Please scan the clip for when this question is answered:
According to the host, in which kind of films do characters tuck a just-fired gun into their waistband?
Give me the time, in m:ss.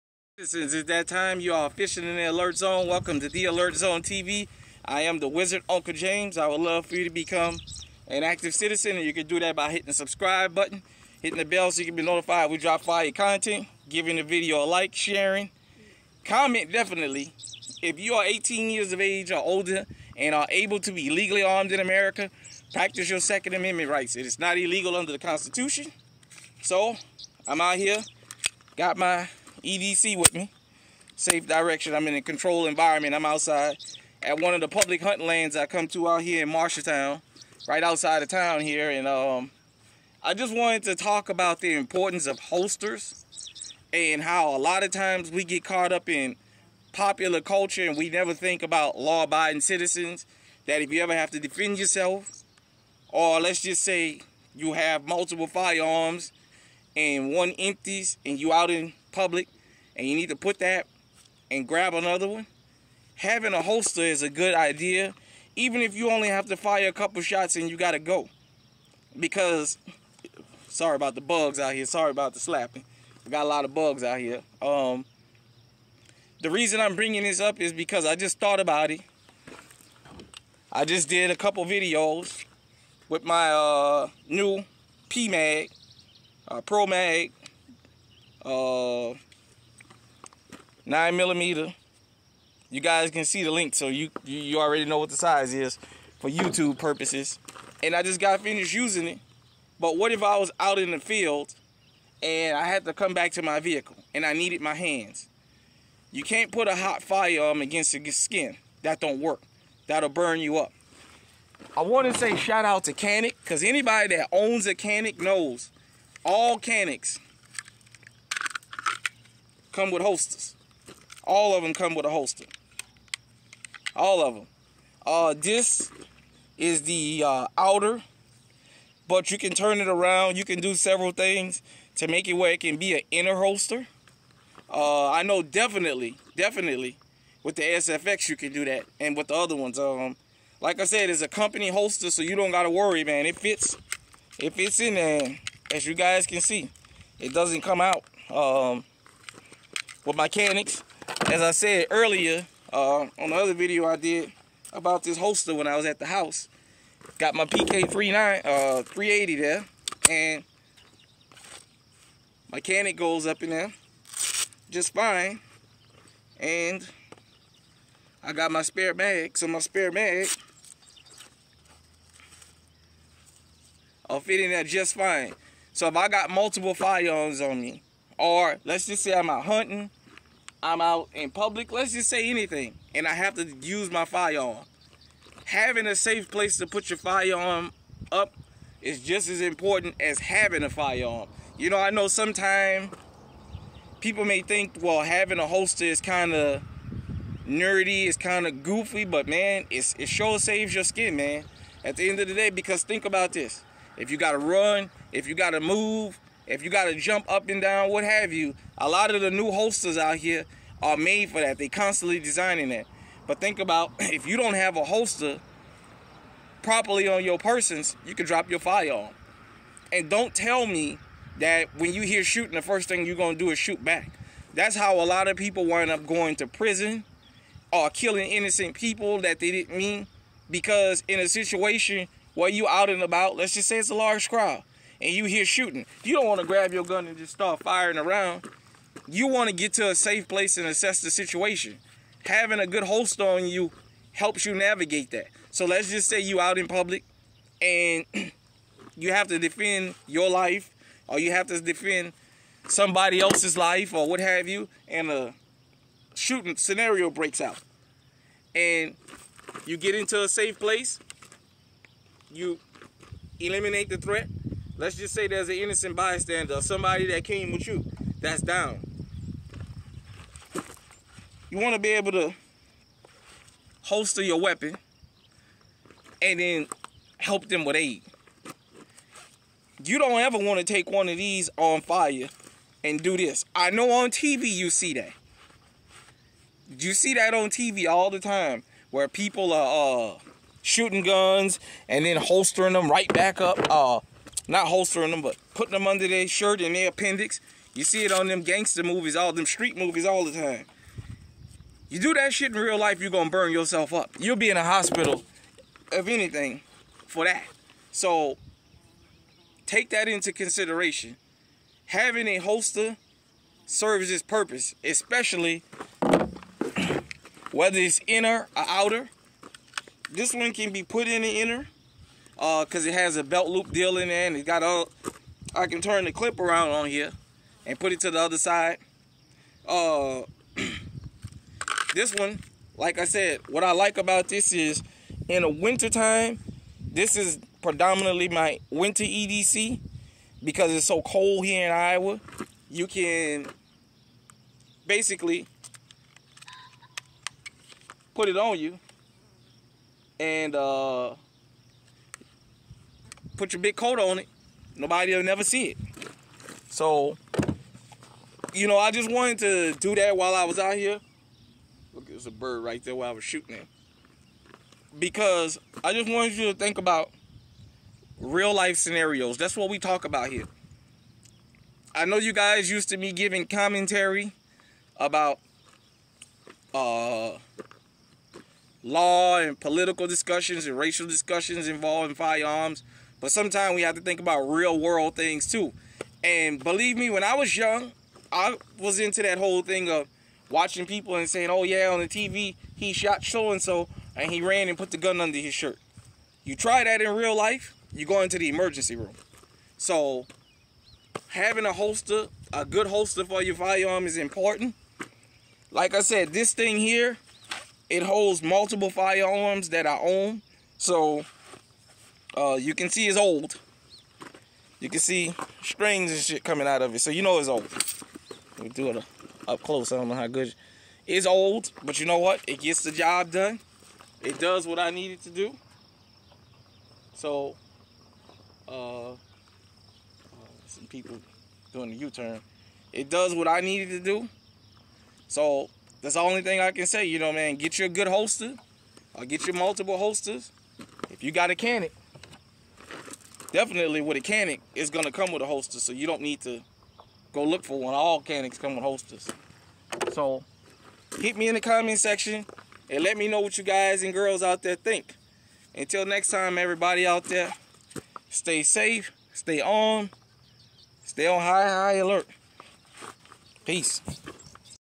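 4:58.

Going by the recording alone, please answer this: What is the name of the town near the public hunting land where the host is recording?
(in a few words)
Marshalltown.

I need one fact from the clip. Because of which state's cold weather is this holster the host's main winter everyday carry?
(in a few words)
Iowa.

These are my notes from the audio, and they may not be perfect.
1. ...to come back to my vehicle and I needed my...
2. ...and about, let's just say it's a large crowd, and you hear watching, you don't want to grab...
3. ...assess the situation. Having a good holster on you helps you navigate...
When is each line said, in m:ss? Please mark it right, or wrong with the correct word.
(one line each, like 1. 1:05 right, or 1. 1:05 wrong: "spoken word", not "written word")
1. 1:42 right
2. 3:52 wrong: "shooting", not "watching"
3. 4:00 right.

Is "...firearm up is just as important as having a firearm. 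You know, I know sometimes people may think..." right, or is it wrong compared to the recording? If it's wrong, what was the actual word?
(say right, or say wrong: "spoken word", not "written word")
right.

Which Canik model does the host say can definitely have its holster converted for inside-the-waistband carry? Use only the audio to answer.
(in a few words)
SFX.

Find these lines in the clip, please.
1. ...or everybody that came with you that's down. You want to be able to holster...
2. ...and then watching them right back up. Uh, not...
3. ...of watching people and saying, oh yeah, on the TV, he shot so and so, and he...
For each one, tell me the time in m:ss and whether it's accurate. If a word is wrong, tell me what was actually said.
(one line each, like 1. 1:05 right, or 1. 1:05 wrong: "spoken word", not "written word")
1. 4:26 wrong: "somebody", not "everybody"
2. 4:51 wrong: "holstering", not "watching"
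3. 6:29 right.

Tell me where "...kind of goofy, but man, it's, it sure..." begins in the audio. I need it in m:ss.
3:18.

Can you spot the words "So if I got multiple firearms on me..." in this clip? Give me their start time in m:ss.
2:55.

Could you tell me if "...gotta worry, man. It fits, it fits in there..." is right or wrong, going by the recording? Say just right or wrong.
right.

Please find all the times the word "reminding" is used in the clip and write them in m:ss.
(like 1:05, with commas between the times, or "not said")
not said.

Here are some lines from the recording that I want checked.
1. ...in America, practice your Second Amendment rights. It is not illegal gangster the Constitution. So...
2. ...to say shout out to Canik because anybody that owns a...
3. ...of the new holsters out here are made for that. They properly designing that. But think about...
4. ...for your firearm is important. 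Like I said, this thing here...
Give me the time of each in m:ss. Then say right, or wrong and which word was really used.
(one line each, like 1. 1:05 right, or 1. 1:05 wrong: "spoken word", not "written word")
1. 0:21 wrong: "under", not "gangster"
2. 1:52 right
3. 3:29 wrong: "constantly", not "properly"
4. 6:43 right.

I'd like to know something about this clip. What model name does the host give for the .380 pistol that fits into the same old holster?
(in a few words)
PK39.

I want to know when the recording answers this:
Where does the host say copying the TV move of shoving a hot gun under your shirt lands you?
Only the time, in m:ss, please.
6:38.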